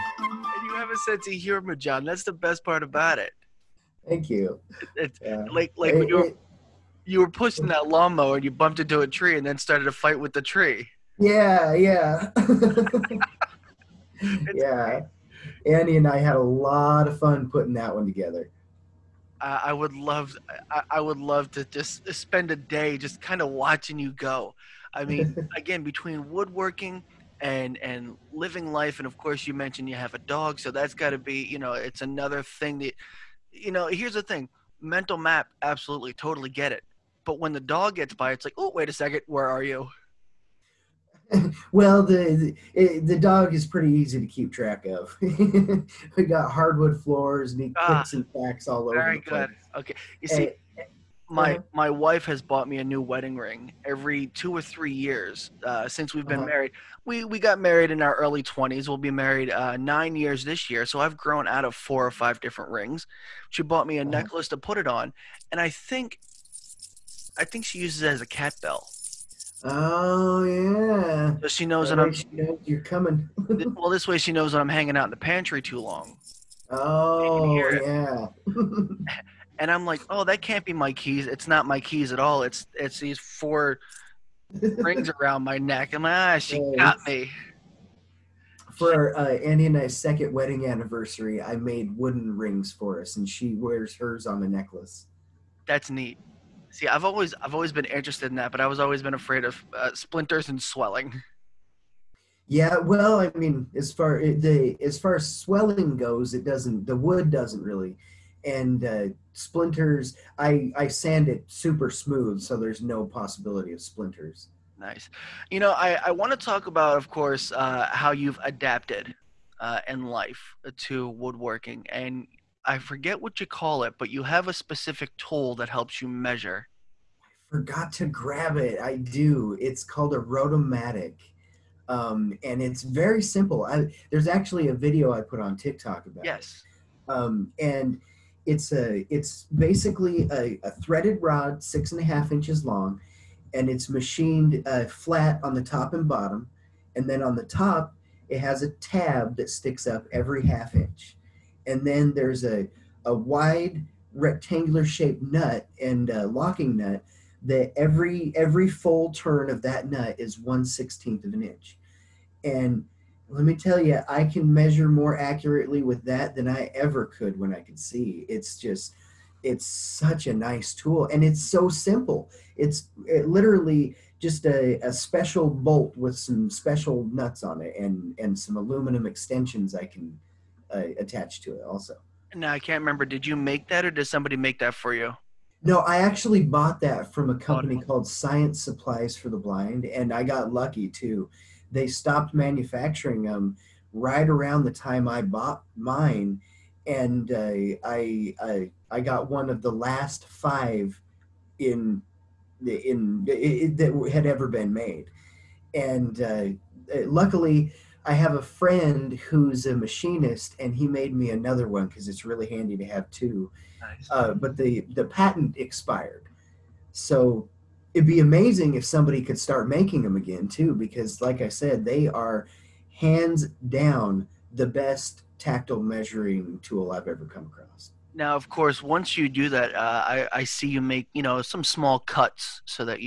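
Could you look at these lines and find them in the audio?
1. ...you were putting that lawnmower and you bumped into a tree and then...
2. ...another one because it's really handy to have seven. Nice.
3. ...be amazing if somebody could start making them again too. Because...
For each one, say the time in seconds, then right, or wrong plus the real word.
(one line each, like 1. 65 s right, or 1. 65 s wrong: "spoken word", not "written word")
1. 7 s wrong: "pushing", not "putting"
2. 211 s wrong: "two", not "seven"
3. 218 s right.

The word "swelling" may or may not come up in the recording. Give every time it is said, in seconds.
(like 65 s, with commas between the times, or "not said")
100 s, 105 s.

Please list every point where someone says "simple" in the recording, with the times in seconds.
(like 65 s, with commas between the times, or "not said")
133 s, 171 s.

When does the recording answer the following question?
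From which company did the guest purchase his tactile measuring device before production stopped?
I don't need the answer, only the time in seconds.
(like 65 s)
188 s.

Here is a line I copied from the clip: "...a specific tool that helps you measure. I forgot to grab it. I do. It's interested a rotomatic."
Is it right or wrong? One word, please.
wrong.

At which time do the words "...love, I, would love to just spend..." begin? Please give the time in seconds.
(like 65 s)
19 s.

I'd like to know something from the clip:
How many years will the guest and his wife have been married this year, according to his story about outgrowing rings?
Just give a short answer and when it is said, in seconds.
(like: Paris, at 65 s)
9, at 59 s.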